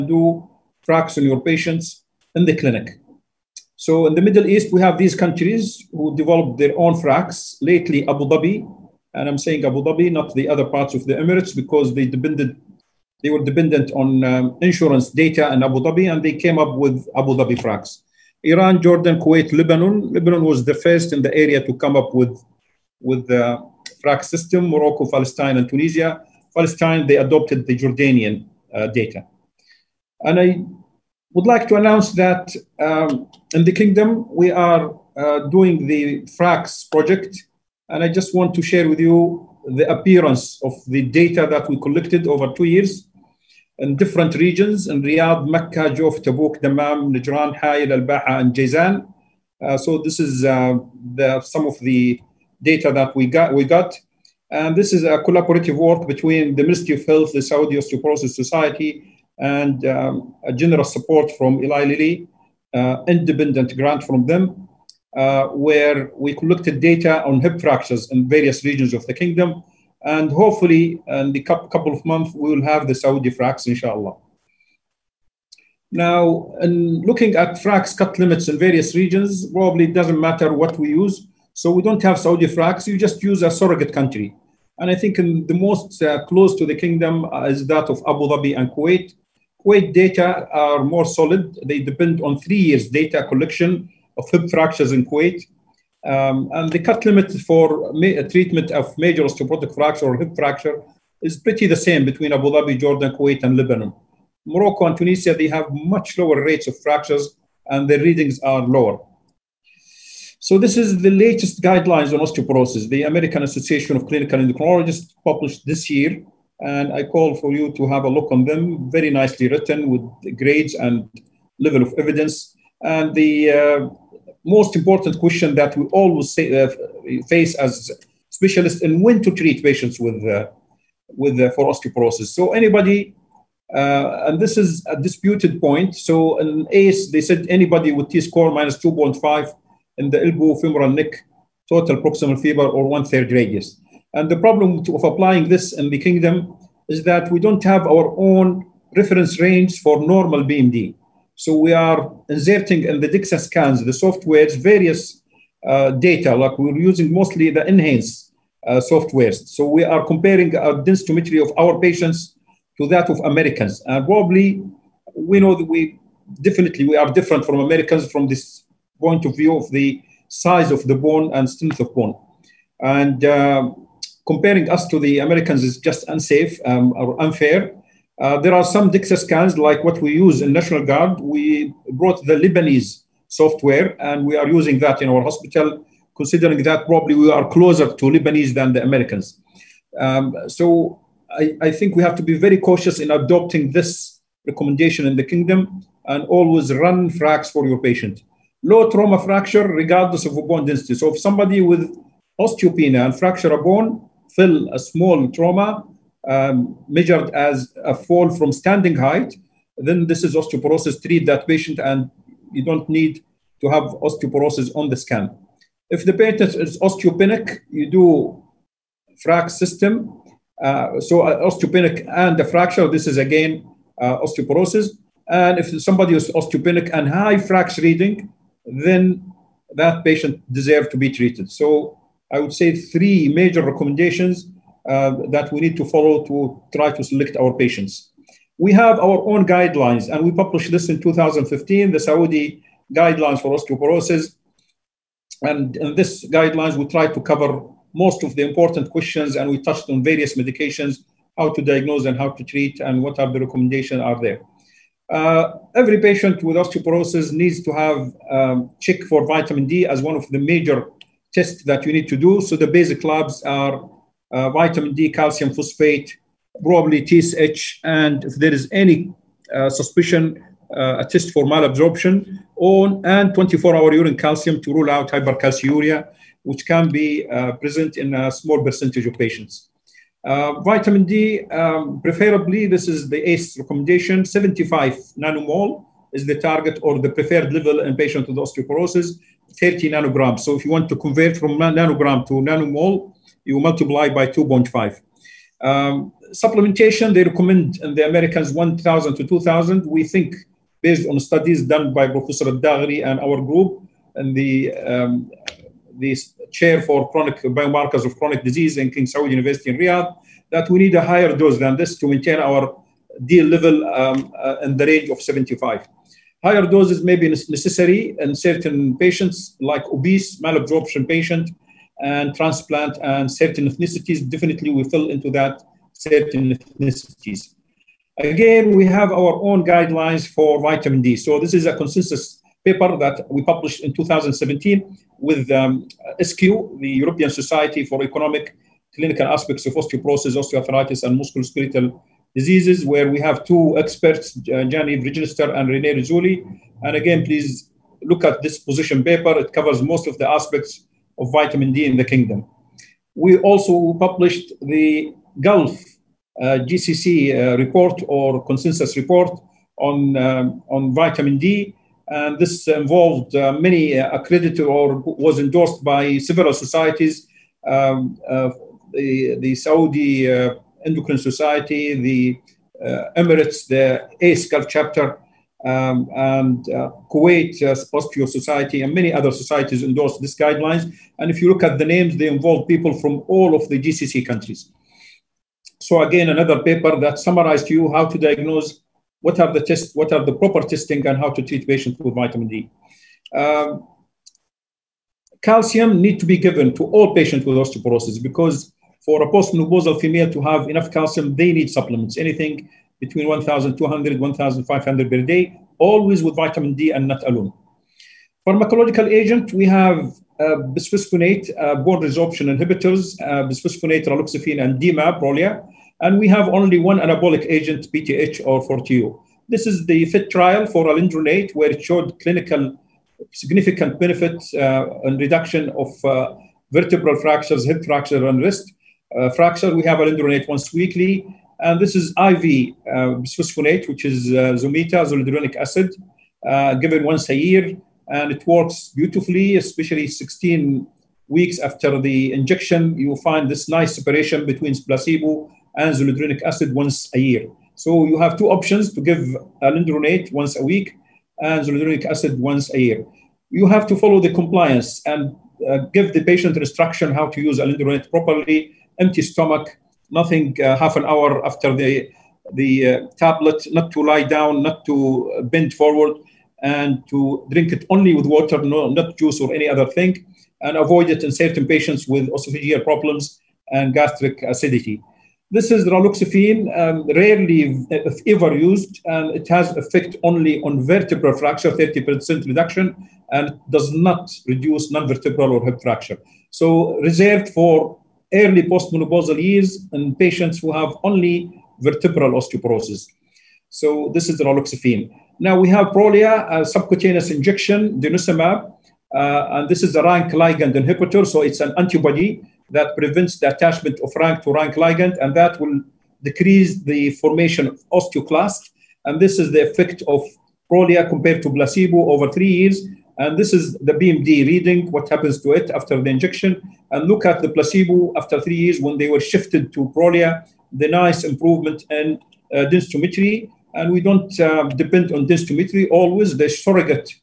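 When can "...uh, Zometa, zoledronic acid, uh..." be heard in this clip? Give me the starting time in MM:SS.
07:14.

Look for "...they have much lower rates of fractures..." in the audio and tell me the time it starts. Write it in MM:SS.
01:45.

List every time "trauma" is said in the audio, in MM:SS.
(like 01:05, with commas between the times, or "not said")
03:18, 03:25.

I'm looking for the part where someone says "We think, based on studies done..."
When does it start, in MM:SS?
04:59.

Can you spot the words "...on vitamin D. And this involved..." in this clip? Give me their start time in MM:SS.
06:00.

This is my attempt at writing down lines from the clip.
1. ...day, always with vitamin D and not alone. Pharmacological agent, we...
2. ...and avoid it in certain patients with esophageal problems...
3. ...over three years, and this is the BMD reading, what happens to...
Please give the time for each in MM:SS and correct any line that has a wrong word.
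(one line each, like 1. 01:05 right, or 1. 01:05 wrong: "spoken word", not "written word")
1. 06:45 right
2. 07:50 right
3. 08:32 right.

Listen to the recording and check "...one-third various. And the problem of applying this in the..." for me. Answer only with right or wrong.
wrong.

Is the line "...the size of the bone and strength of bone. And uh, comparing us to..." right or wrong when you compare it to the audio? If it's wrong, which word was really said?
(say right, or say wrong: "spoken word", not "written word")
right.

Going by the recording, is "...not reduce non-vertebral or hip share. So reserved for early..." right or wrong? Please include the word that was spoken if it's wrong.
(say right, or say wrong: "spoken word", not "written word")
wrong: "fracture", not "share".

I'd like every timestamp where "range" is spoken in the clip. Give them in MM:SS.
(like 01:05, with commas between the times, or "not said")
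02:29, 05:14.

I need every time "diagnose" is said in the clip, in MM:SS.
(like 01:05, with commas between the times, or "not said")
04:11, 06:28.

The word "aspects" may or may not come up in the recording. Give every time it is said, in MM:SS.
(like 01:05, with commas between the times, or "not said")
05:39, 05:50.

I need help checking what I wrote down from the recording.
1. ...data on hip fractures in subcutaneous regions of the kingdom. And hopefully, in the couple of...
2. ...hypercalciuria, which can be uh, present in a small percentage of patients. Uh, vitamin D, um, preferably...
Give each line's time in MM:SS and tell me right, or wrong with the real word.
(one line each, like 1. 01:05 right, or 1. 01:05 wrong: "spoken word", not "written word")
1. 01:06 wrong: "various", not "subcutaneous"
2. 04:35 right.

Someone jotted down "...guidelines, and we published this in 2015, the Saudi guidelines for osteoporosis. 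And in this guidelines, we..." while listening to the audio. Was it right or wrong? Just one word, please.
right.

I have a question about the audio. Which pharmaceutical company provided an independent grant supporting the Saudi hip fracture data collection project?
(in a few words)
Eli Lilly.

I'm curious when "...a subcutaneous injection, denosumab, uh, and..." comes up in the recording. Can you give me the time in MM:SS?
08:16.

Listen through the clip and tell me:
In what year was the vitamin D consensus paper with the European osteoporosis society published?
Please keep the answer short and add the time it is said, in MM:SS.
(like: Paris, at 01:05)
2017, at 05:33.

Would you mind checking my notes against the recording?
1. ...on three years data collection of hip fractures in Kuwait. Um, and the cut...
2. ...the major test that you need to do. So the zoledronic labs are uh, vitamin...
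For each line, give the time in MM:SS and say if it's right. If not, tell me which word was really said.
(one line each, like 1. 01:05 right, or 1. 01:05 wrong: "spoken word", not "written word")
1. 01:32 right
2. 04:20 wrong: "basic", not "zoledronic".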